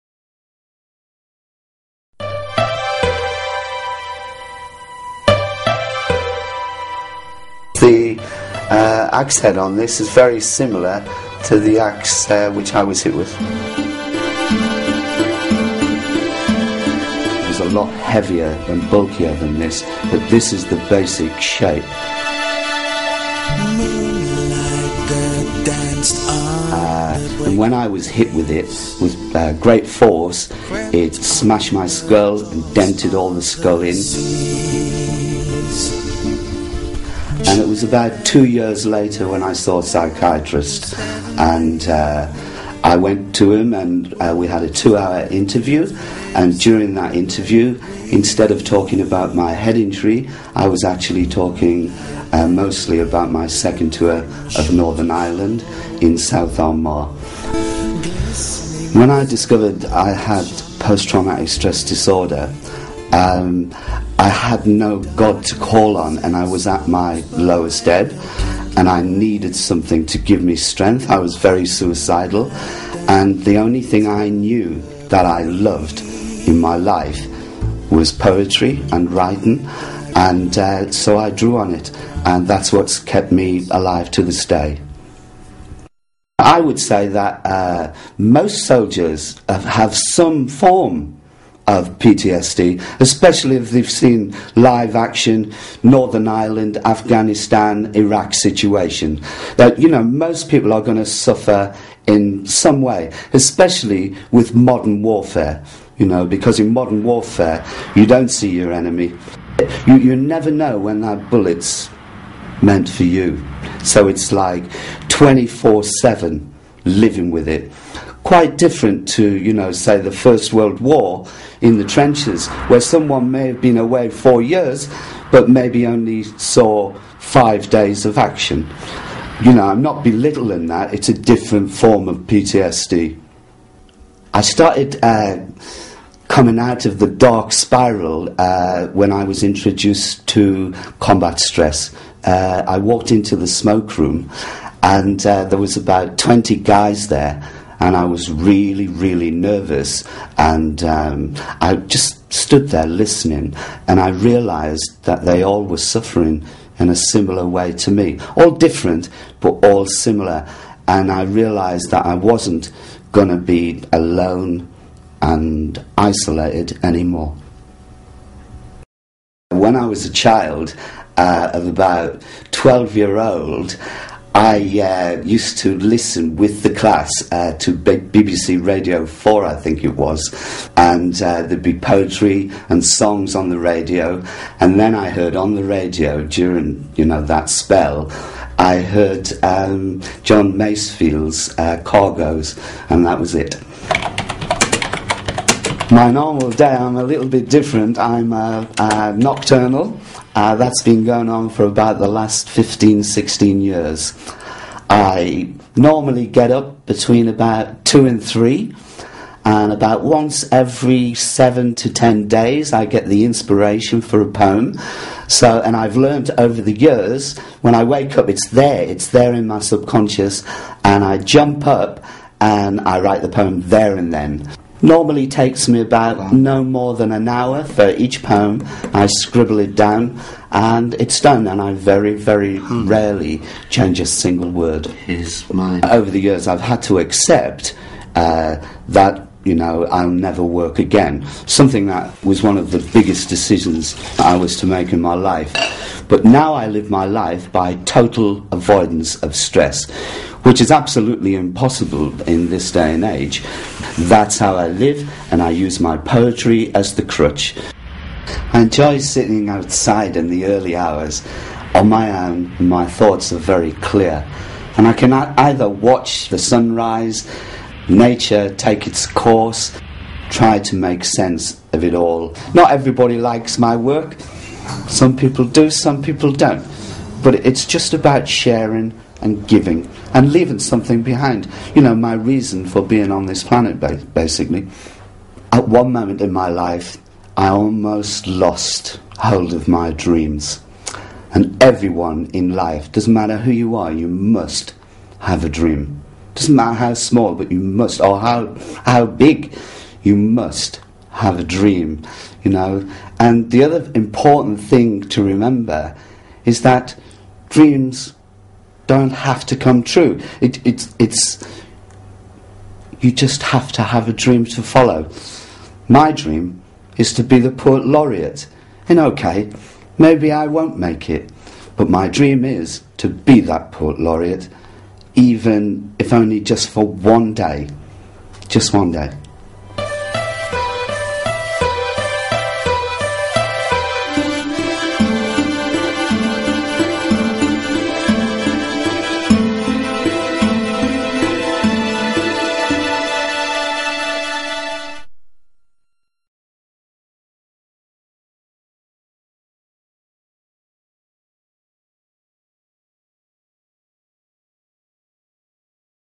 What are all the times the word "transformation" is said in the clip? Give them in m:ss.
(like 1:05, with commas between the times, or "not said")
not said.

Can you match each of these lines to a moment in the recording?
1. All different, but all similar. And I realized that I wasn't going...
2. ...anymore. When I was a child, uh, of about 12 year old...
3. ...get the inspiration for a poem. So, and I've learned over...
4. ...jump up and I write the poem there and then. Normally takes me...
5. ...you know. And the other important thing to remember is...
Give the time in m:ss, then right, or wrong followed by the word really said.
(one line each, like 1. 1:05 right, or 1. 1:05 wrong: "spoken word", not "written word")
1. 2:38 right
2. 2:46 right
3. 3:32 right
4. 3:41 right
5. 5:02 right.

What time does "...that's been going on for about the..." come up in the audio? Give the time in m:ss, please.
3:20.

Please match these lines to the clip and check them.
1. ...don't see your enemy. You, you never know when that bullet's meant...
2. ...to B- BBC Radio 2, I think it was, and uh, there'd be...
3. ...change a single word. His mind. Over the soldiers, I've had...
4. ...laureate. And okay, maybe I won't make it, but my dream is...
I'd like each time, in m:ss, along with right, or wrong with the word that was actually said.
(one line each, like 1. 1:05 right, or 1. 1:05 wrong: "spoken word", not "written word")
1. 1:48 right
2. 2:57 wrong: "4", not "2"
3. 3:53 wrong: "years", not "soldiers"
4. 5:17 right.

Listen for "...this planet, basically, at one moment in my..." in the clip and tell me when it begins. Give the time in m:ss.
4:43.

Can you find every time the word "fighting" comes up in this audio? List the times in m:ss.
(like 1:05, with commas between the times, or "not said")
not said.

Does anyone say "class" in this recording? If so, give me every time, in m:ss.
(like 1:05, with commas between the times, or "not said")
2:56.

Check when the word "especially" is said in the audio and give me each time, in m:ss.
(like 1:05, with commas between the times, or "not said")
1:32, 1:43.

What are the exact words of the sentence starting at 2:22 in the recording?
Uh, I walked into the smoke room, and uh, there was about 20 guys there and I was really, really nervous.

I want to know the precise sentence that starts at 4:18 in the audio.
I enjoy sitting outside in the early hours.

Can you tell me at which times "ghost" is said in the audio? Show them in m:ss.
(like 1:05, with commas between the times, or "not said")
not said.